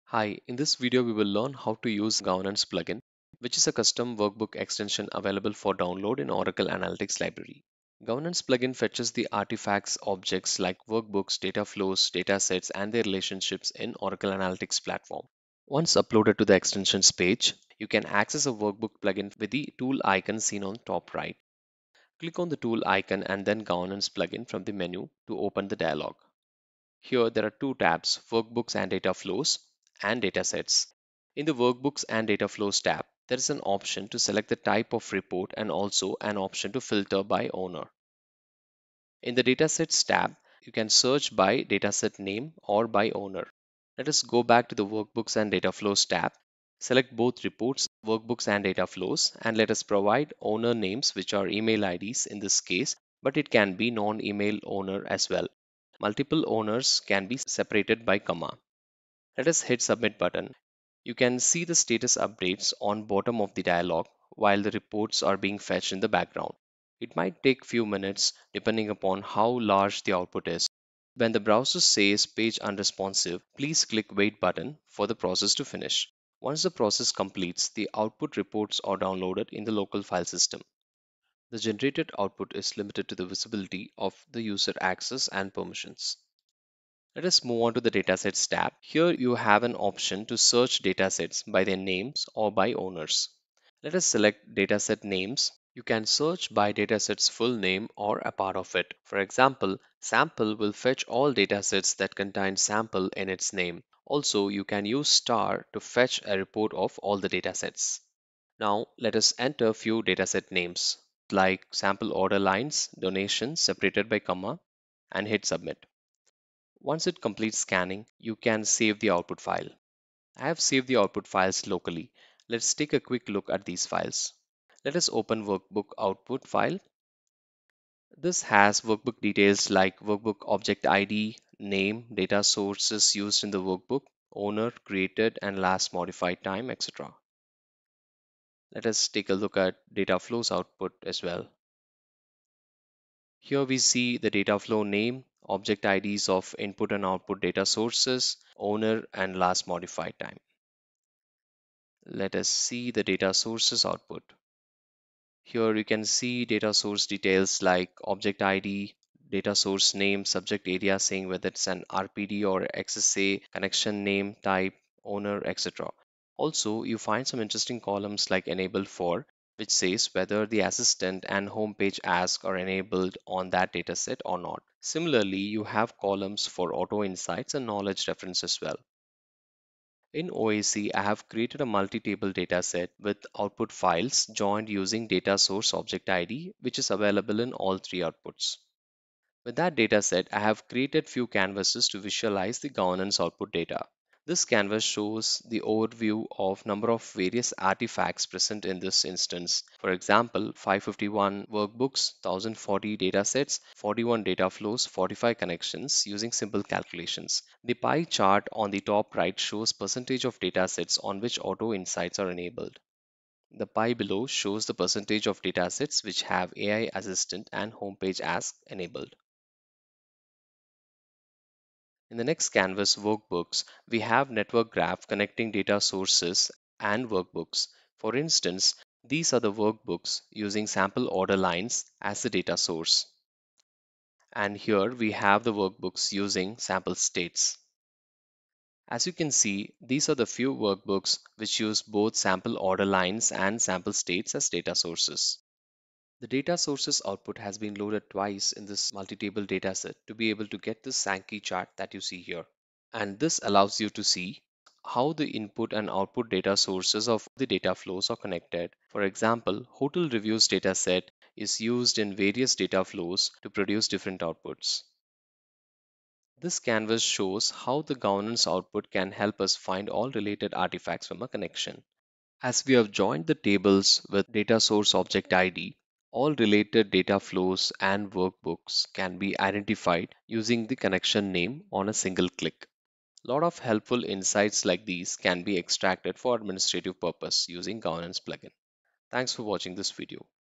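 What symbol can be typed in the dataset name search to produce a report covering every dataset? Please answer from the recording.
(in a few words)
star.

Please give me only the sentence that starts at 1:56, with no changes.
Once it completes scanning, you can save the output file.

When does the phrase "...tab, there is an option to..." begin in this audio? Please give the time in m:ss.
0:32.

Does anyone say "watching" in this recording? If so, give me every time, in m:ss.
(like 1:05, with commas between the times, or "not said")
4:49.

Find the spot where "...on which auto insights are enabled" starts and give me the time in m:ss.
3:31.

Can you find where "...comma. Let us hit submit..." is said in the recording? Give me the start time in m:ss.
0:58.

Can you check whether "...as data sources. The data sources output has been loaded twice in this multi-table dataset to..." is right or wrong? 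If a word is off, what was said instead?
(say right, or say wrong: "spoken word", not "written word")
right.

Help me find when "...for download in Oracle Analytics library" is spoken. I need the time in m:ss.
0:05.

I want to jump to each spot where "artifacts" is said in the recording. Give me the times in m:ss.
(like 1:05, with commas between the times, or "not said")
0:09, 3:17, 4:30.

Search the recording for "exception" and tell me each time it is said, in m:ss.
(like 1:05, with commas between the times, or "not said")
not said.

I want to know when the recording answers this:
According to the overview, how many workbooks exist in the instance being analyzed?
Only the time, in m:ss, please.
3:20.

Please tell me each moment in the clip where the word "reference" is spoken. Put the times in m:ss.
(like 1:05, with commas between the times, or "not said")
2:58.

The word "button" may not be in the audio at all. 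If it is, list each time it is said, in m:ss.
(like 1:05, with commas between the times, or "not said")
1:00, 1:14.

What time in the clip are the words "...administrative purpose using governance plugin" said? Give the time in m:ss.
4:46.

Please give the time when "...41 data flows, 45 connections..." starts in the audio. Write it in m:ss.
3:23.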